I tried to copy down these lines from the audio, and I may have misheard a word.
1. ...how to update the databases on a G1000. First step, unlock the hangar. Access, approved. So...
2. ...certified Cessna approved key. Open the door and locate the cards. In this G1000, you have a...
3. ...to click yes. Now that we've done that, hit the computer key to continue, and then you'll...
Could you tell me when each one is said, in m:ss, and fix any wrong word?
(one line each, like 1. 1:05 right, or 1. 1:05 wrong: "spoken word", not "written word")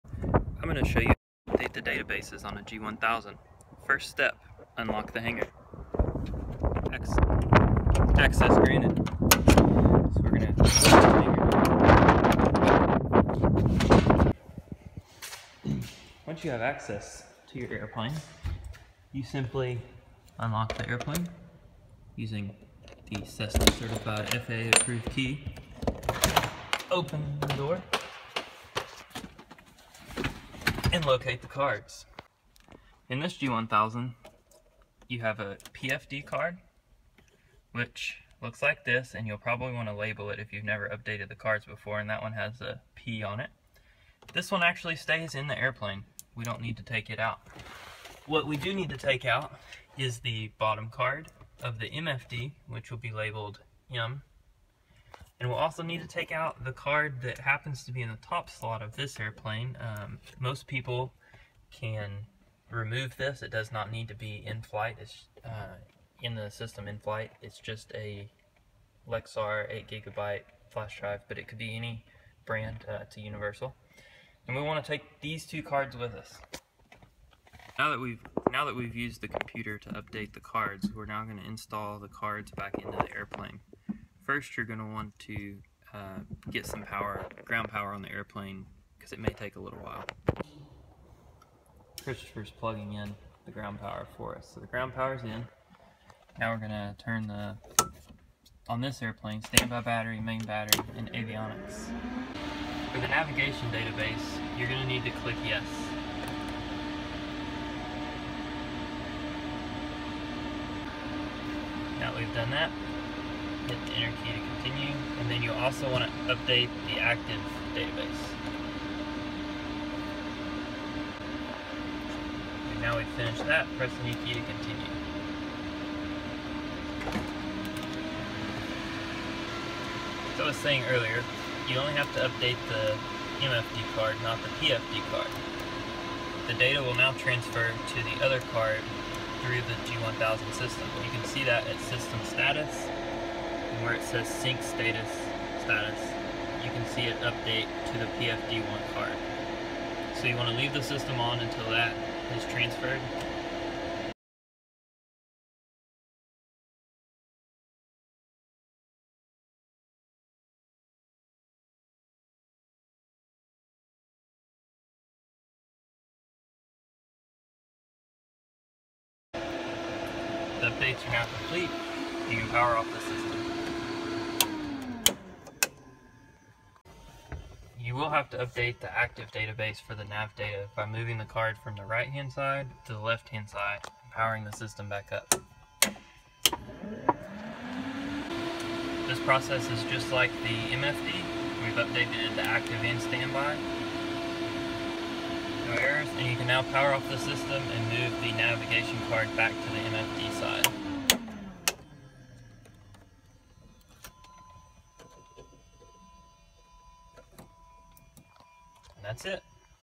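1. 0:01 wrong: "granted", not "approved"
2. 0:23 wrong: "FAA", not "Cessna"
3. 1:45 wrong: "enter", not "computer".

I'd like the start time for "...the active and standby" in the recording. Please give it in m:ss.
3:12.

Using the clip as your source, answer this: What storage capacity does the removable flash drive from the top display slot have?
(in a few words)
8 gigabytes.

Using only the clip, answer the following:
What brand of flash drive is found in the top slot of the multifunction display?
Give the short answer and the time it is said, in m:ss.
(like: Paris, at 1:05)
Lexar, at 1:09.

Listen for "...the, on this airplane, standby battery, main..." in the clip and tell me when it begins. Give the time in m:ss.
1:37.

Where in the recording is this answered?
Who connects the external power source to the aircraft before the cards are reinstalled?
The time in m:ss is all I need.
1:32.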